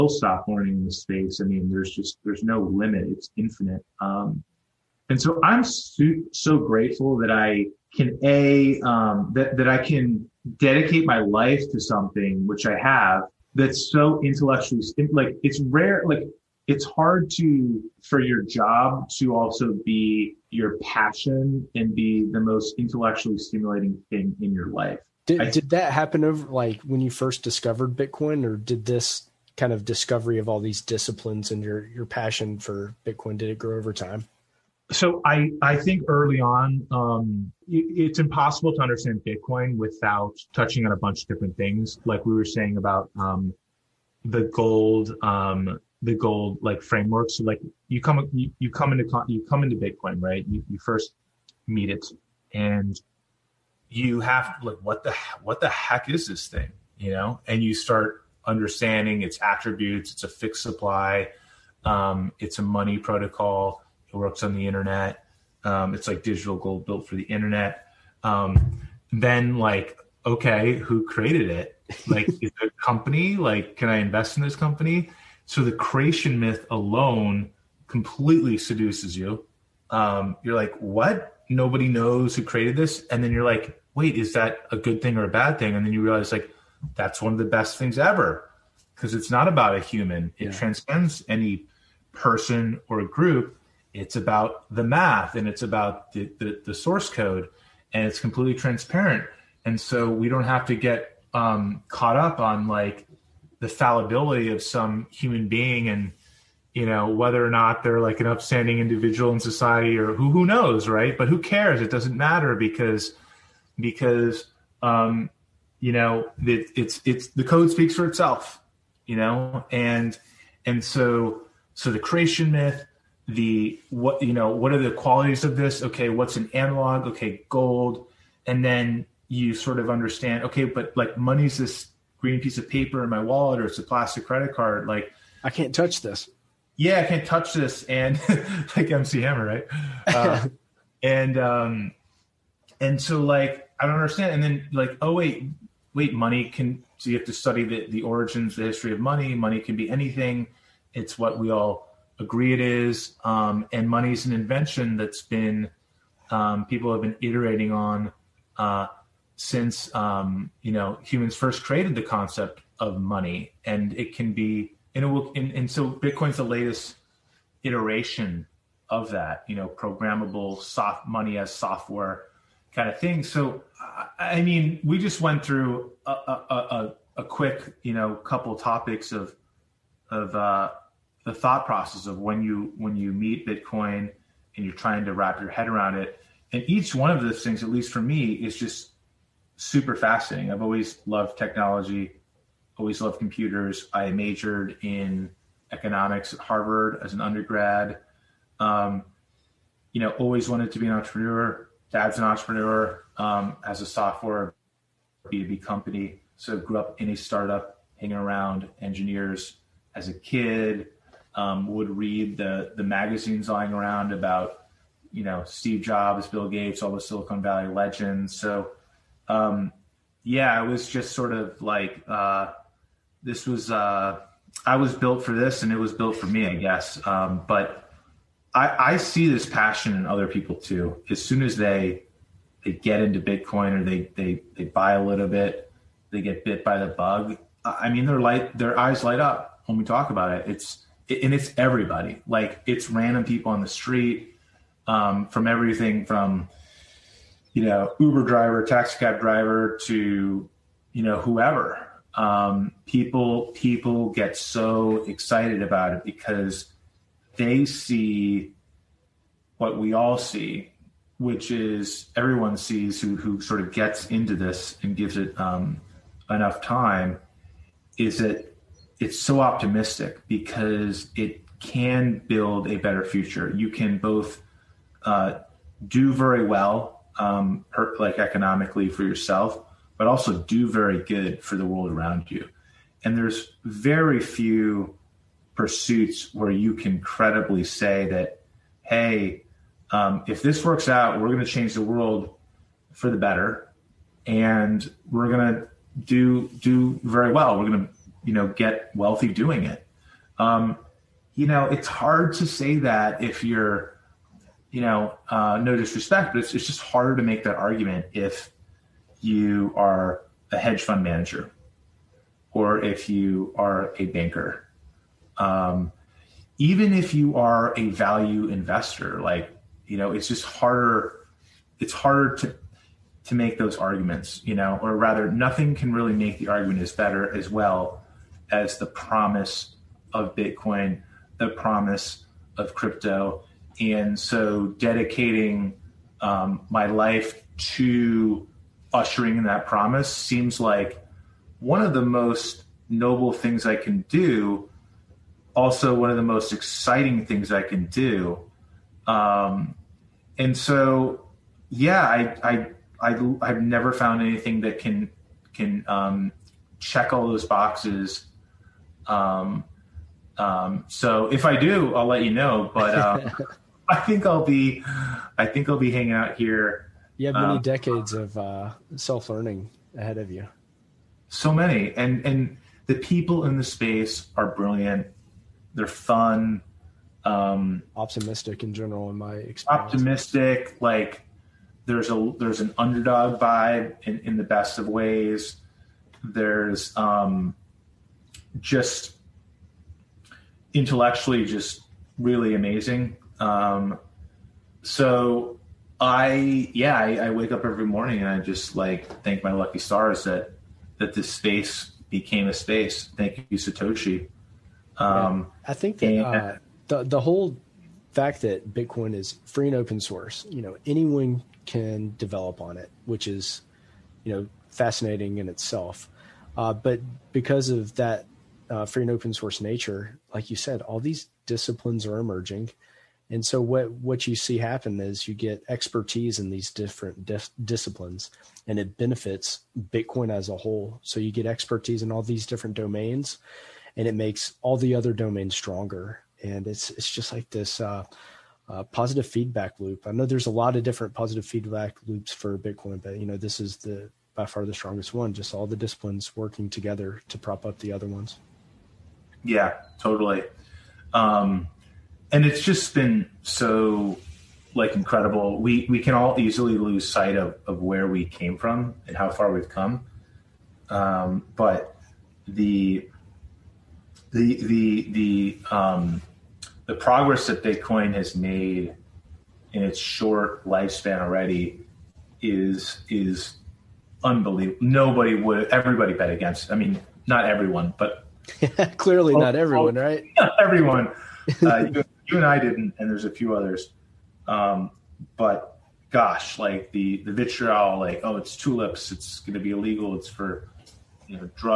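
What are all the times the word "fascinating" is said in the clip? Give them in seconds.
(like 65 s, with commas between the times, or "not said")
189 s, 414 s.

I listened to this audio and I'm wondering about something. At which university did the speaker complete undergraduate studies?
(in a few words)
Harvard.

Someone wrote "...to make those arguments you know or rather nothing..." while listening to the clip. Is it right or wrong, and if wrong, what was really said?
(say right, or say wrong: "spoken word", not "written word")
right.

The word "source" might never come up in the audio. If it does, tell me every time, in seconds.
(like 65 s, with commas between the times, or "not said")
96 s, 409 s, 419 s.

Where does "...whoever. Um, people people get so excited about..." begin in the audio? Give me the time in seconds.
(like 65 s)
251 s.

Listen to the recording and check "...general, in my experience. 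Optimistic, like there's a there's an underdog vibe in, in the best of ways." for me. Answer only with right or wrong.
right.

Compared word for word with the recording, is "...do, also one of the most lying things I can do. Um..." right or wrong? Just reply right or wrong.
wrong.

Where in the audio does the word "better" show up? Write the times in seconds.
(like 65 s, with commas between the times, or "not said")
272 s, 293 s, 326 s.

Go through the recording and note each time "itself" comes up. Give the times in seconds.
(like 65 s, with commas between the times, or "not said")
118 s, 415 s.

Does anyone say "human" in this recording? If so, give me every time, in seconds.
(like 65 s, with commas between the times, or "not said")
89 s, 105 s, 161 s.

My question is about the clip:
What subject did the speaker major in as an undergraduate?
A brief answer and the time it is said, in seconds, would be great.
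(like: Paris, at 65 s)
Economics, at 195 s.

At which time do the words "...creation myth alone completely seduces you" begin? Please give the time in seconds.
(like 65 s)
75 s.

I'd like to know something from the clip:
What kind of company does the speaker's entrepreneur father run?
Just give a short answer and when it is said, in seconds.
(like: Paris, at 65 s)
B2B software company, at 203 s.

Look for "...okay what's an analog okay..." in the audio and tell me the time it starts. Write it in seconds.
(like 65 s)
125 s.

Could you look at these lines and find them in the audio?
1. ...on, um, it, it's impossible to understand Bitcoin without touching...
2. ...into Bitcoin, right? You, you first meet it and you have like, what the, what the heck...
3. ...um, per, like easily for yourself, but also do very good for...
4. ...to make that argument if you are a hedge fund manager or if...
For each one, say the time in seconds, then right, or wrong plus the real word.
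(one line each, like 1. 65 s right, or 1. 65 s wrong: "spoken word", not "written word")
1. 36 s right
2. 49 s right
3. 277 s wrong: "economically", not "easily"
4. 307 s right.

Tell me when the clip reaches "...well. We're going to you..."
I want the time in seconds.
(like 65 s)
297 s.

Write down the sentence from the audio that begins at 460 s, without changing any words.
Um, but the the the the um, the progress that Bitcoin has made in its short lifespan already is is unbelievable.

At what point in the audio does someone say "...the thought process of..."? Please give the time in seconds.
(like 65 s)
181 s.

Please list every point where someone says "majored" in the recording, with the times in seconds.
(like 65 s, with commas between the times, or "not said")
194 s.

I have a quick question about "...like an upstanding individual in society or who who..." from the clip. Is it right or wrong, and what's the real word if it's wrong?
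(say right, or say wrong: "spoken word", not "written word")
right.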